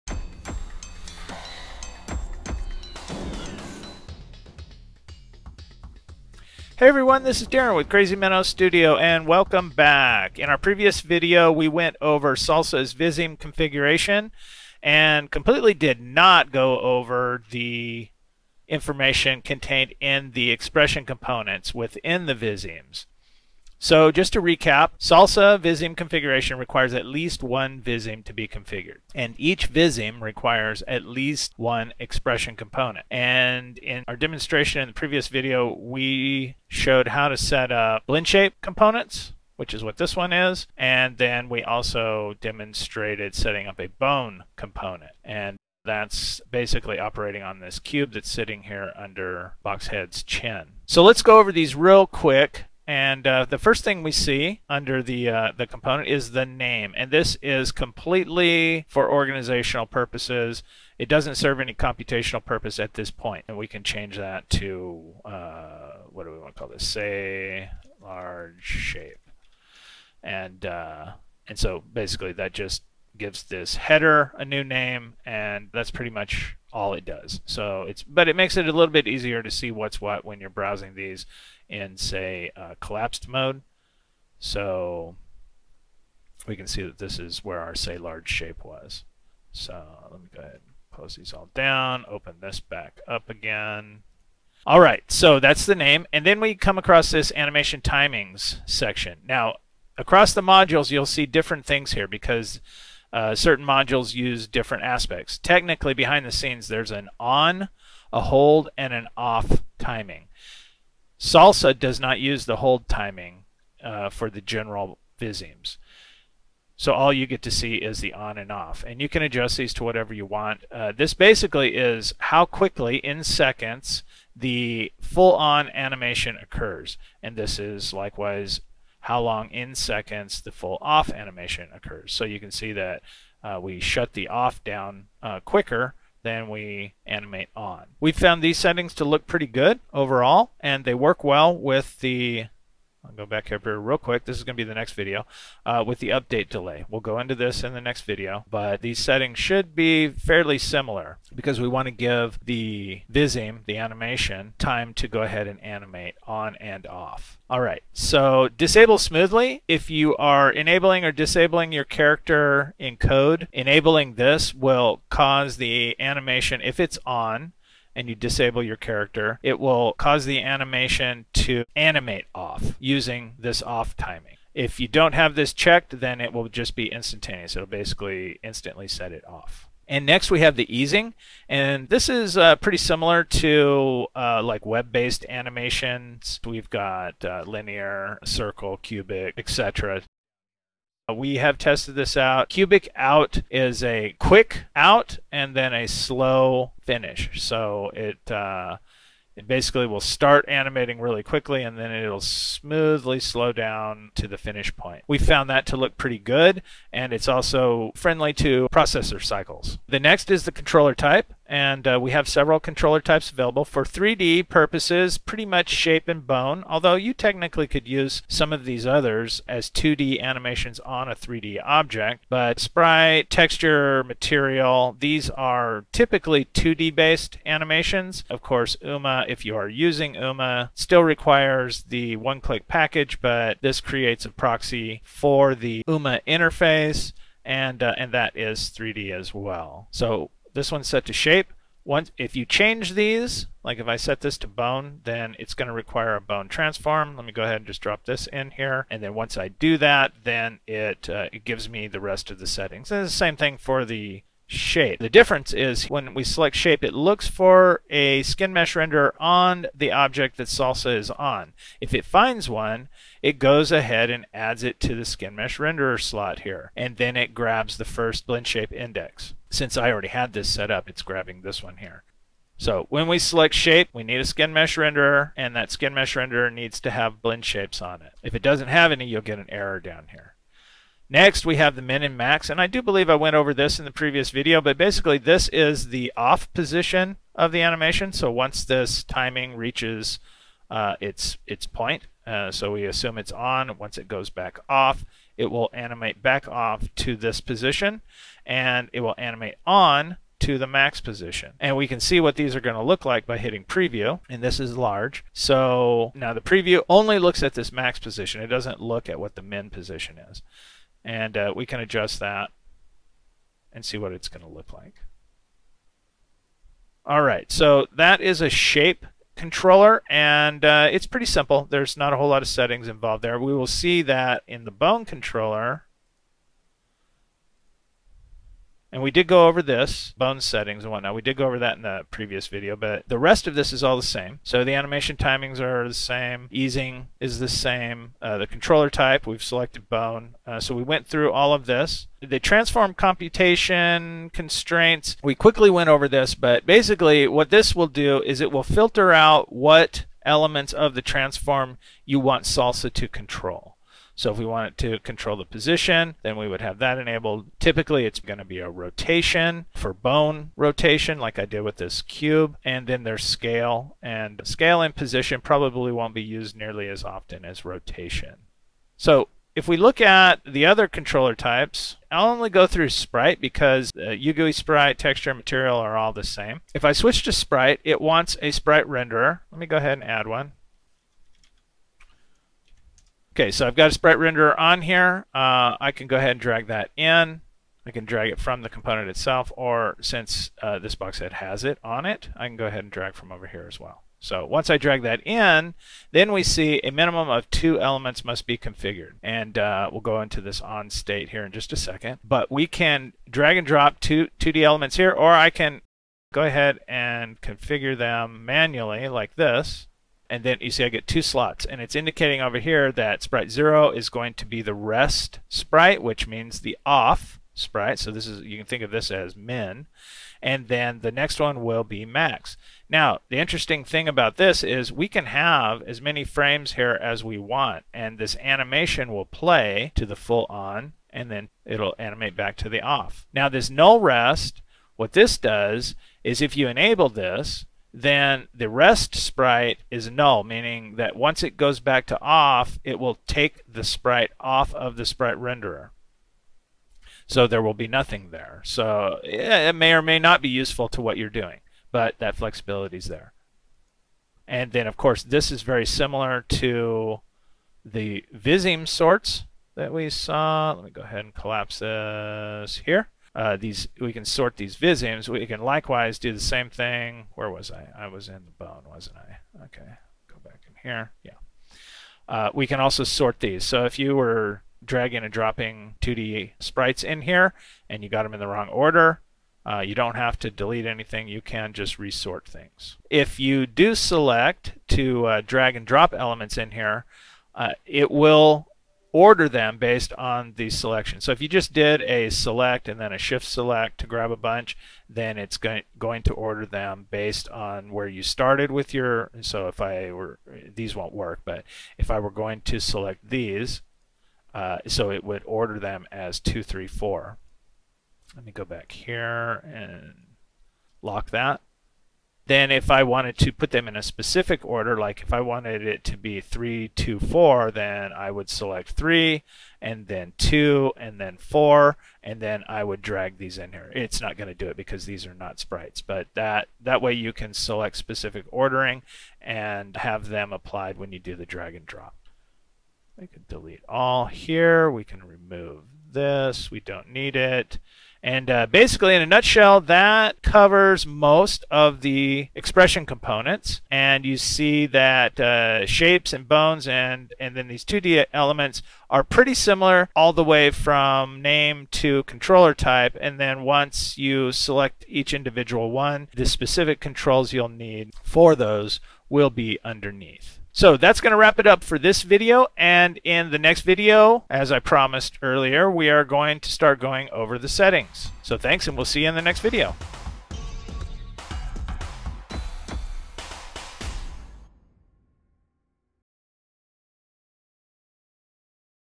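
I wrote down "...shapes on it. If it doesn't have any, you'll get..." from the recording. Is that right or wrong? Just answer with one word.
right.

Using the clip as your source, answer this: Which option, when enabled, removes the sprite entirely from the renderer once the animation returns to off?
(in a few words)
Null rest.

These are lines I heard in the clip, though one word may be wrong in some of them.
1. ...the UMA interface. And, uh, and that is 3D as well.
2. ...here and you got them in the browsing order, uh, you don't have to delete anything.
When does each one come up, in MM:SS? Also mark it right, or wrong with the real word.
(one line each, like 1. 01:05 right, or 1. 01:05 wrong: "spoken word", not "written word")
1. 03:55 right
2. 07:57 wrong: "wrong", not "browsing".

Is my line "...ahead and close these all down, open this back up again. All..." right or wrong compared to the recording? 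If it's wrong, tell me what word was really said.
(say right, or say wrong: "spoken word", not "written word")
right.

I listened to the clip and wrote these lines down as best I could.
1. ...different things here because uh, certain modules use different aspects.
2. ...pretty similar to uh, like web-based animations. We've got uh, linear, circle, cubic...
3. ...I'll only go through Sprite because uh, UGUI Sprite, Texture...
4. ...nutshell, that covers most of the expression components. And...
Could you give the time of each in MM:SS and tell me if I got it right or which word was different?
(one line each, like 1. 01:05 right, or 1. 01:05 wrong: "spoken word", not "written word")
1. 01:41 right
2. 03:02 right
3. 06:12 right
4. 08:59 right.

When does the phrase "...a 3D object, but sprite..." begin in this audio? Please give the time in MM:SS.
03:41.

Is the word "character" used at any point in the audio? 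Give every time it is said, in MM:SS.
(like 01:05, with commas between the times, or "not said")
02:41, 02:48.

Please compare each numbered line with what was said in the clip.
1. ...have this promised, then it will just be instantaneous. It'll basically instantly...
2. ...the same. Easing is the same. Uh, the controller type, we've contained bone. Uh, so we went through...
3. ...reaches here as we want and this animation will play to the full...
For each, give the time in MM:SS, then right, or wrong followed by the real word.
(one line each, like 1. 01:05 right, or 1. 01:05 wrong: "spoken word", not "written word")
1. 02:55 wrong: "checked", not "promised"
2. 05:35 wrong: "selected", not "contained"
3. 07:06 wrong: "frames", not "reaches".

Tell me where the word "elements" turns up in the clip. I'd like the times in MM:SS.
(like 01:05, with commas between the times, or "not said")
05:50, 06:37, 06:44, 08:06, 09:08.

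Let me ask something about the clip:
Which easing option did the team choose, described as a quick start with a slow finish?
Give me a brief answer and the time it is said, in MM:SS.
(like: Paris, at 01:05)
Cubic out, at 03:12.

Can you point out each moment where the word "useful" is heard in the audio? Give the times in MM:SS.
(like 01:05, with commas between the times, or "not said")
07:30.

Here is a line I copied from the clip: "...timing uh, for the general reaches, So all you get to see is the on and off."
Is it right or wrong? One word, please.
wrong.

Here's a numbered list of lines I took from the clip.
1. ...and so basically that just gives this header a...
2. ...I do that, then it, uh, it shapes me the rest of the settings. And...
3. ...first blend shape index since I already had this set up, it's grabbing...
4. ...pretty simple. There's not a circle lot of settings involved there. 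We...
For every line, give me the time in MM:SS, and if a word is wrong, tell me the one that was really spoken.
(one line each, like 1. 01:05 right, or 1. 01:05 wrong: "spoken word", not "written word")
1. 01:11 right
2. 04:09 wrong: "gives", not "shapes"
3. 04:27 right
4. 05:21 wrong: "whole", not "circle".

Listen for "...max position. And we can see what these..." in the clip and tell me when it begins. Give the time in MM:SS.
05:00.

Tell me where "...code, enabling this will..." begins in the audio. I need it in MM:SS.
02:42.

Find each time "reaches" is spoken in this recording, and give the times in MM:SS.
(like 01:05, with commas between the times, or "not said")
04:49.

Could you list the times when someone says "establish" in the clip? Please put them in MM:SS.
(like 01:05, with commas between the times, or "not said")
not said.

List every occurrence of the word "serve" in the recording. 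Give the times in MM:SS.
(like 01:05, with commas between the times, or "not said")
01:01.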